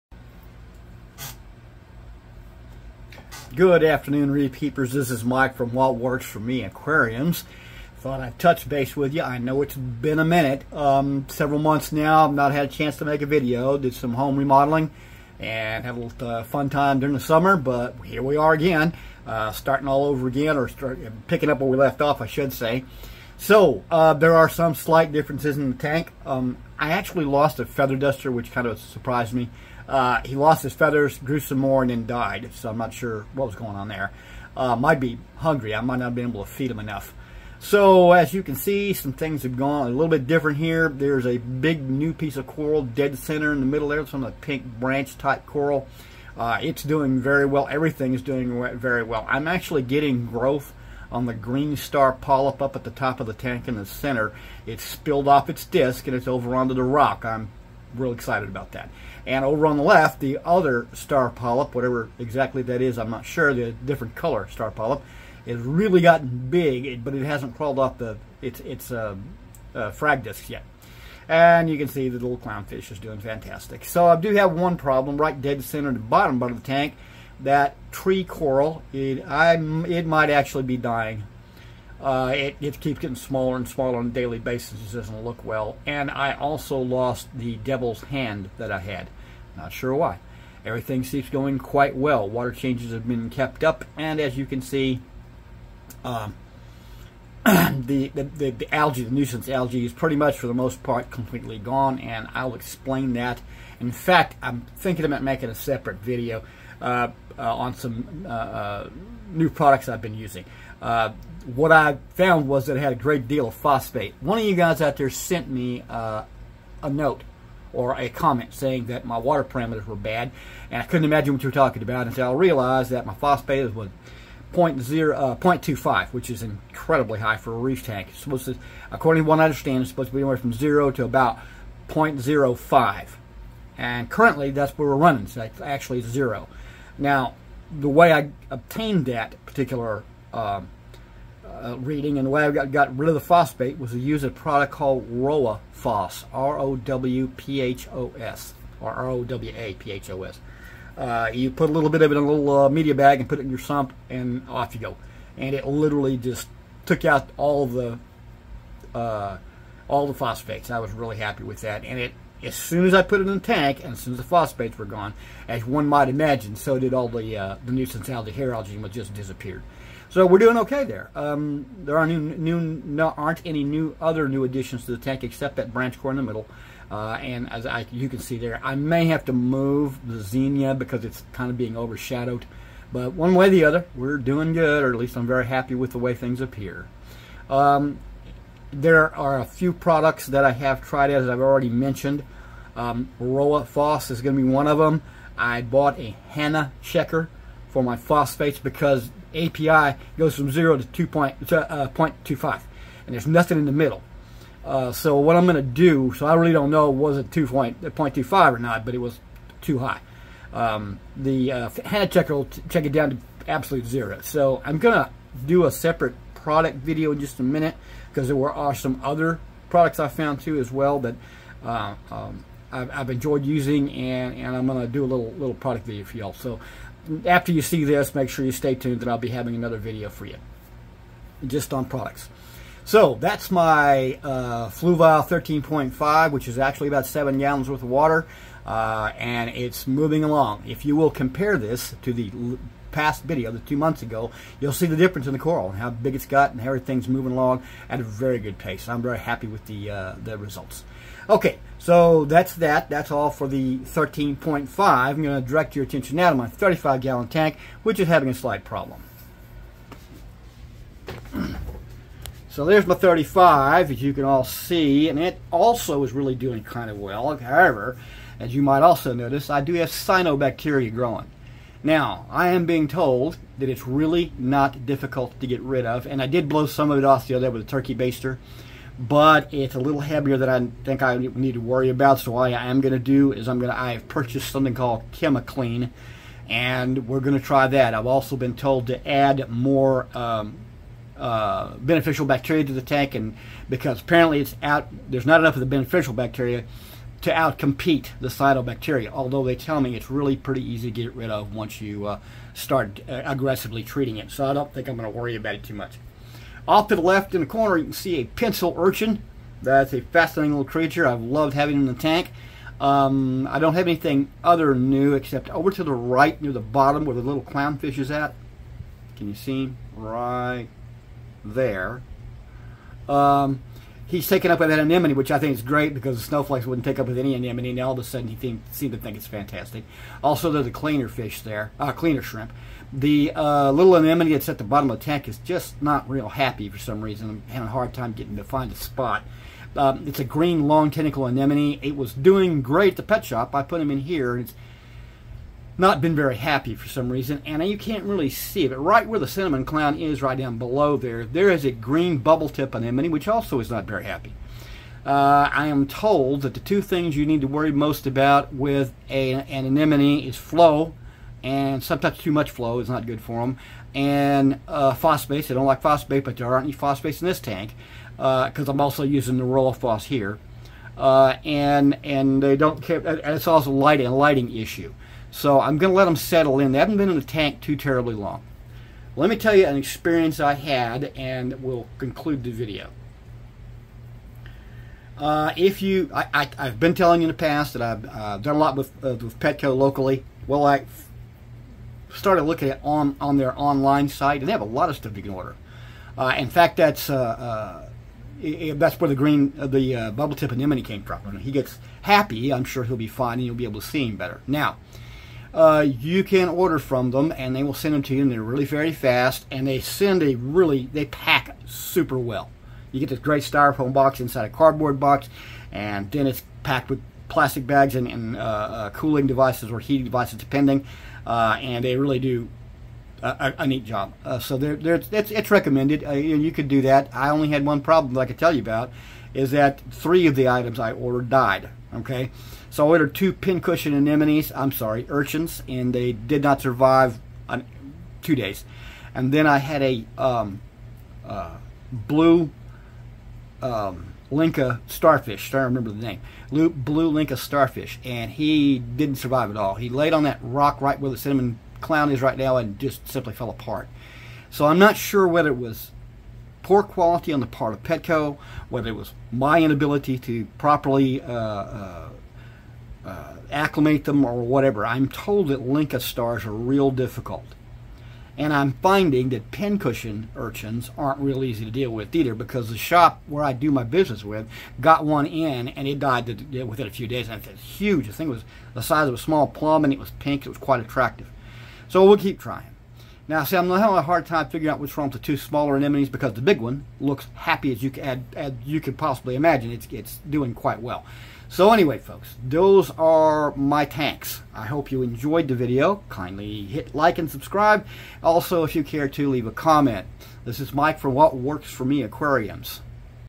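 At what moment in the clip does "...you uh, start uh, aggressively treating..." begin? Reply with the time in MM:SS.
05:01.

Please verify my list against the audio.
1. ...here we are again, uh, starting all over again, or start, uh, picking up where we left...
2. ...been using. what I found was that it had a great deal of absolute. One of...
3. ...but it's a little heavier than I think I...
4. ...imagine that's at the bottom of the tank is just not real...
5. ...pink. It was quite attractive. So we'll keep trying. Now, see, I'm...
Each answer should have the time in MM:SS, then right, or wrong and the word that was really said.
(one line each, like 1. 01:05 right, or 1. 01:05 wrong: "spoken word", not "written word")
1. 00:18 right
2. 01:50 wrong: "phosphate", not "absolute"
3. 04:38 right
4. 05:33 wrong: "anemone", not "imagine"
5. 08:00 right.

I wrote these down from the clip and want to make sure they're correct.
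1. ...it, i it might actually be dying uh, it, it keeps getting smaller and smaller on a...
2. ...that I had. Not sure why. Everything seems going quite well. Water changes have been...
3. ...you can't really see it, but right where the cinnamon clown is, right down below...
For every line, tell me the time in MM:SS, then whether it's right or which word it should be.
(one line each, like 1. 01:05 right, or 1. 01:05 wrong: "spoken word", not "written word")
1. 01:18 right
2. 01:28 right
3. 05:47 right.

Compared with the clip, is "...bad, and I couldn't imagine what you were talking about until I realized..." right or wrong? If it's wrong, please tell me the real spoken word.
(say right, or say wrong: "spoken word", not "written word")
right.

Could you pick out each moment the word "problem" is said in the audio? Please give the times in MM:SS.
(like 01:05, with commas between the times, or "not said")
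01:14, 04:18, 07:07.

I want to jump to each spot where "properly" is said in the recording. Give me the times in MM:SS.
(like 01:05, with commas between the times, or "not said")
07:40.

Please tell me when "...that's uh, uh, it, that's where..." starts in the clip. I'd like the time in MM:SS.
06:36.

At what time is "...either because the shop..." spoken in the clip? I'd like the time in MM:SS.
07:52.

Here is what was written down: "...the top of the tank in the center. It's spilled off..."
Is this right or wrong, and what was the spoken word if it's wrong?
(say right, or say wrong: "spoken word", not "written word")
right.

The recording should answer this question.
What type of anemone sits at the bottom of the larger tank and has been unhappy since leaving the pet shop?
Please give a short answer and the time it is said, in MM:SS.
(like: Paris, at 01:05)
green long tentacle anemone, at 05:40.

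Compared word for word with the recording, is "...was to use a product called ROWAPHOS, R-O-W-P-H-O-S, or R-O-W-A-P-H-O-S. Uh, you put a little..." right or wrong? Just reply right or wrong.
right.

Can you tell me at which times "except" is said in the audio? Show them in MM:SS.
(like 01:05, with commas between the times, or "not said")
02:55, 05:15.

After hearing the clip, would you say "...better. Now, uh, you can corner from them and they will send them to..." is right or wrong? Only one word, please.
wrong.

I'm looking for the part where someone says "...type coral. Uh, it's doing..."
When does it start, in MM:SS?
00:45.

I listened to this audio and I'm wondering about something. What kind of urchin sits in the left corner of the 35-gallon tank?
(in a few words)
pencil urchin.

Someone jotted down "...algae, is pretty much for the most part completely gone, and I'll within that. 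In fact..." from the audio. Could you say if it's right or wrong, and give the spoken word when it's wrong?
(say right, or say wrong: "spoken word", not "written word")
wrong: "explain", not "within".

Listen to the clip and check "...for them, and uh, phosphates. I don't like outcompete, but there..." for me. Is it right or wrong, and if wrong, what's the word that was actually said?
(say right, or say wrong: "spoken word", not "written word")
wrong: "phosphate", not "outcompete".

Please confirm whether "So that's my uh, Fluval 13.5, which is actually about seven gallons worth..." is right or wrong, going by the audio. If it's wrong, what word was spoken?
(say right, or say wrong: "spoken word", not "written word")
right.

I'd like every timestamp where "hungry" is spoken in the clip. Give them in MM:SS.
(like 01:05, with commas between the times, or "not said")
00:35.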